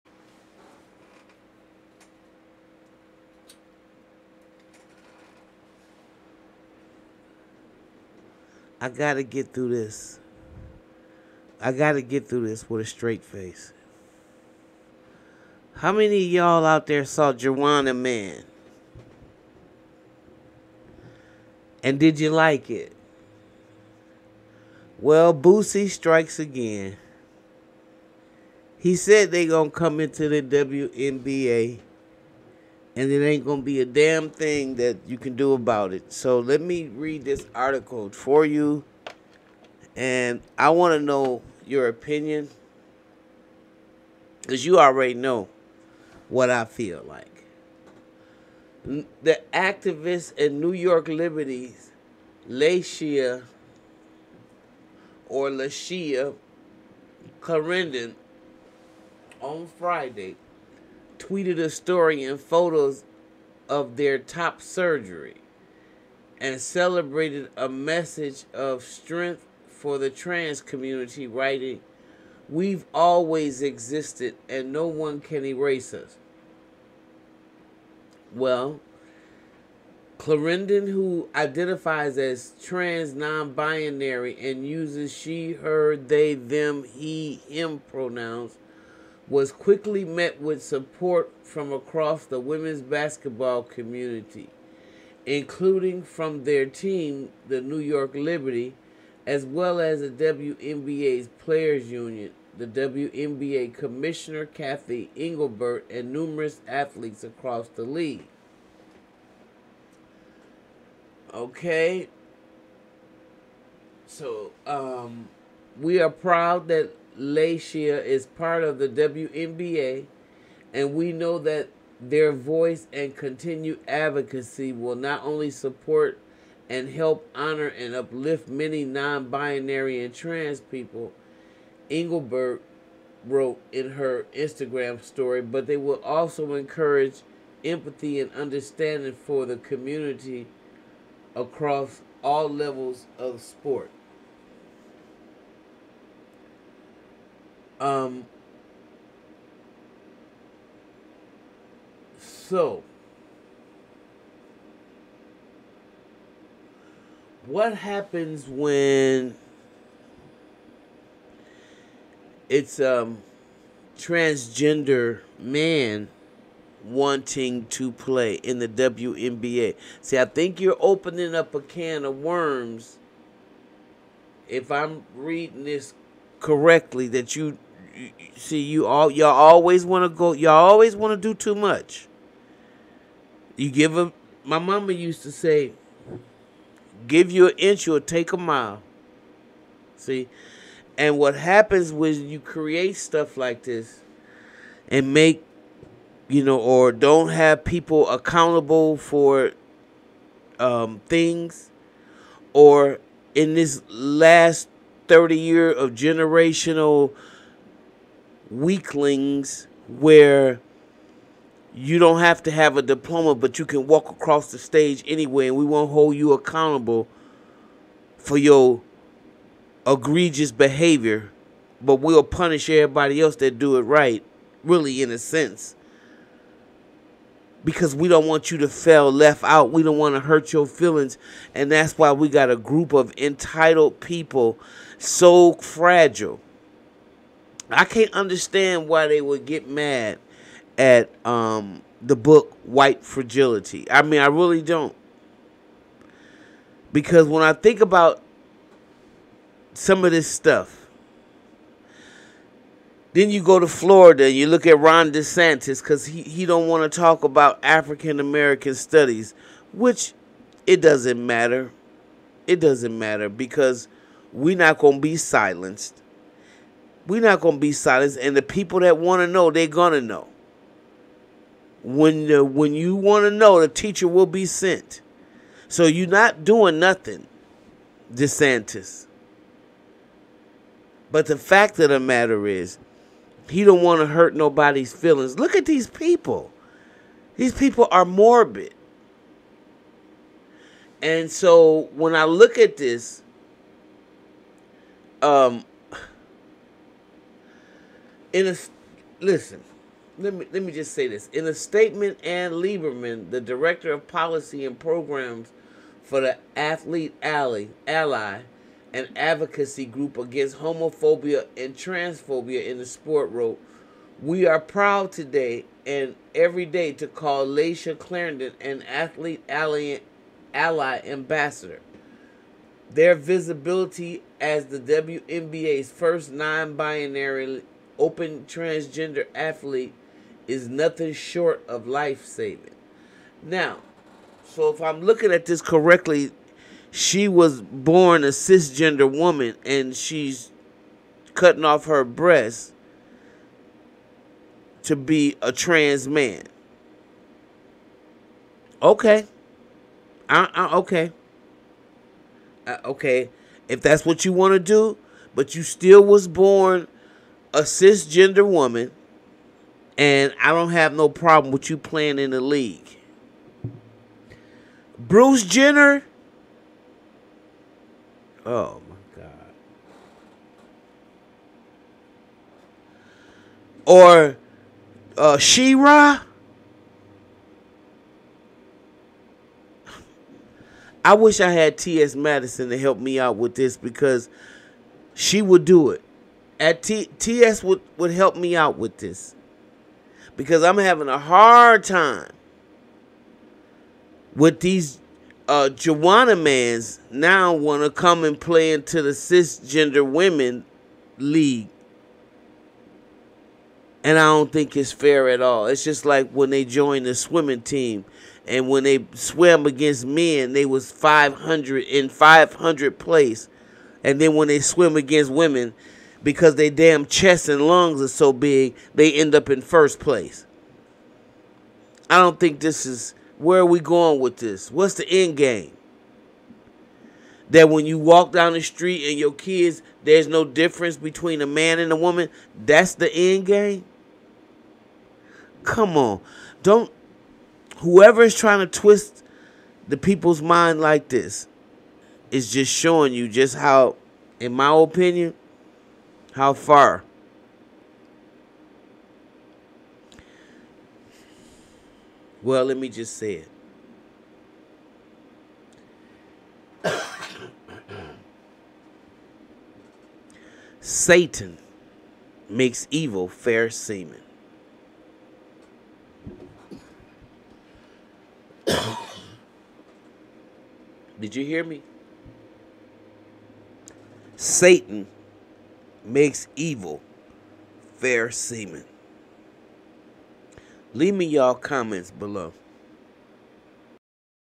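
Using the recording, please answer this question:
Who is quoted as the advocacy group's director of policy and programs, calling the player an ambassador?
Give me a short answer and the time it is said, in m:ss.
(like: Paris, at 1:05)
Anne Lieberman, at 5:02.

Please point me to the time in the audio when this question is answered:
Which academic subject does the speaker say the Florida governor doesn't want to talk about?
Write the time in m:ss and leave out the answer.
4:17.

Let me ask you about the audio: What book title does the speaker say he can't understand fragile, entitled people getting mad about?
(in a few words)
White Fragility.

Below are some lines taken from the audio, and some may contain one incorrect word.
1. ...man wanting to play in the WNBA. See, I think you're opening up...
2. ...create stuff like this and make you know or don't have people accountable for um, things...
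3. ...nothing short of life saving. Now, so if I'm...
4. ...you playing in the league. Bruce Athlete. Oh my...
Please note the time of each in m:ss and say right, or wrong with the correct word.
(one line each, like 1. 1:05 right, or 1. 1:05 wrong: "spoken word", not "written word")
1. 2:45 right
2. 3:12 right
3. 5:30 right
4. 6:01 wrong: "Jenner", not "Athlete".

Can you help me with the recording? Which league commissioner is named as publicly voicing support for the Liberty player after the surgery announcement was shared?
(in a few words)
Kathy Engelbert.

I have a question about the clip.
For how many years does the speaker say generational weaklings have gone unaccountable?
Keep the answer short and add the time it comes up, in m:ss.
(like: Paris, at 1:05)
30, at 3:25.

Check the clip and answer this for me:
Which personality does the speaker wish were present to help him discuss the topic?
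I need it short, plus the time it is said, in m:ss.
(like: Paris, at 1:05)
T.S. Madison, at 6:21.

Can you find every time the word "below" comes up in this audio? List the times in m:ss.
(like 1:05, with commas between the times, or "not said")
8:02.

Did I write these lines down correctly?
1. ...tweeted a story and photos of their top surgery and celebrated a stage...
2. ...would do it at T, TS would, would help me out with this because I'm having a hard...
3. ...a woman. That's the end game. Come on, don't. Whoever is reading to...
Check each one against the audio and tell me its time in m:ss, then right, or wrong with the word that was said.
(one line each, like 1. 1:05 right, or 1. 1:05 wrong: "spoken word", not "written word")
1. 1:01 wrong: "message", not "stage"
2. 6:25 right
3. 7:11 wrong: "trying", not "reading".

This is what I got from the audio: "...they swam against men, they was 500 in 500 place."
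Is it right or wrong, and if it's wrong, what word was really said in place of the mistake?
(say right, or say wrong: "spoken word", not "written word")
right.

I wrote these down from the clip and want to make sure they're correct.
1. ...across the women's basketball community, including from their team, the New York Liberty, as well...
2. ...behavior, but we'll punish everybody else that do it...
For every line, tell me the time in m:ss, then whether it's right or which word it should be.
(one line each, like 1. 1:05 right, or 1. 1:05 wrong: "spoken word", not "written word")
1. 1:31 right
2. 3:40 right.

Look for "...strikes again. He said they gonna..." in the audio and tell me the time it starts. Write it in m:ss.
0:25.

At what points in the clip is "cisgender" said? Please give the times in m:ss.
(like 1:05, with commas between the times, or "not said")
5:38, 5:57, 6:39.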